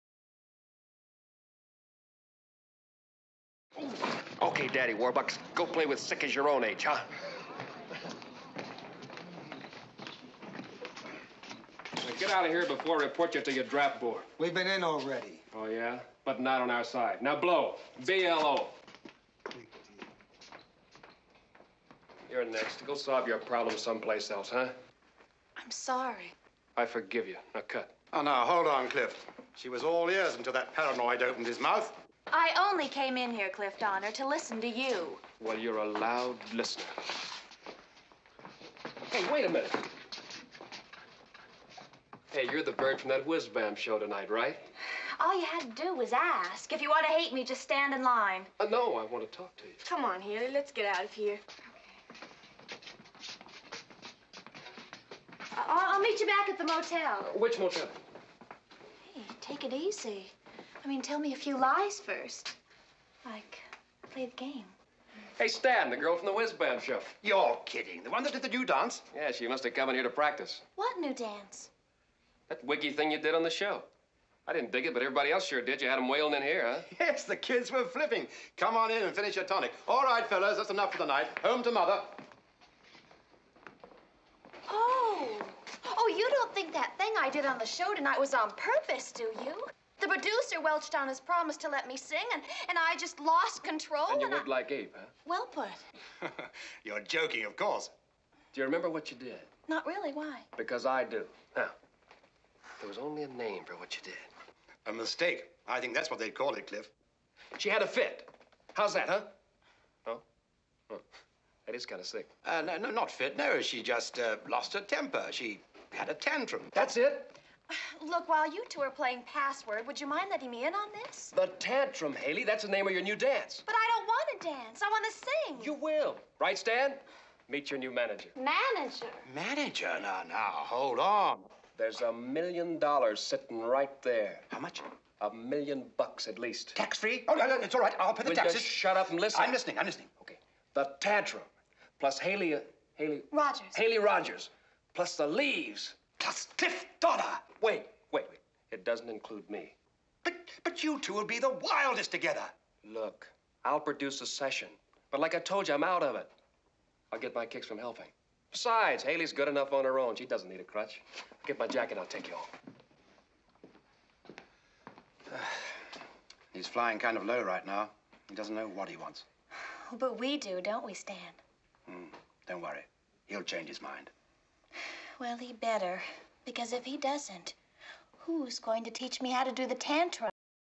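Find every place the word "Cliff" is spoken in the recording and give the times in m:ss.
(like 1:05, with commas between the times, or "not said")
0:28, 0:33, 1:46, 2:26.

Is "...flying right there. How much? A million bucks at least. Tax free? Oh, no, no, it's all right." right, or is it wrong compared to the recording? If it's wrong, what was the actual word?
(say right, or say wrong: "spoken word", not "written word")
wrong: "sitting", not "flying".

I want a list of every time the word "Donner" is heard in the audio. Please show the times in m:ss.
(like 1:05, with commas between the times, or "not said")
0:33, 2:27.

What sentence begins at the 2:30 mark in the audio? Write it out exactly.
But, but you two will be the wildest together.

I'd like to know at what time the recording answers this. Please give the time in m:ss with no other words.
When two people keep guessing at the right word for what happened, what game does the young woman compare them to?
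1:59.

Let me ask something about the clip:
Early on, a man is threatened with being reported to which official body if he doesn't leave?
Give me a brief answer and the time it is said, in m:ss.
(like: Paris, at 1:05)
draft board, at 0:13.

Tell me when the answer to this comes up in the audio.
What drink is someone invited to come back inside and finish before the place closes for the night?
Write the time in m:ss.
1:19.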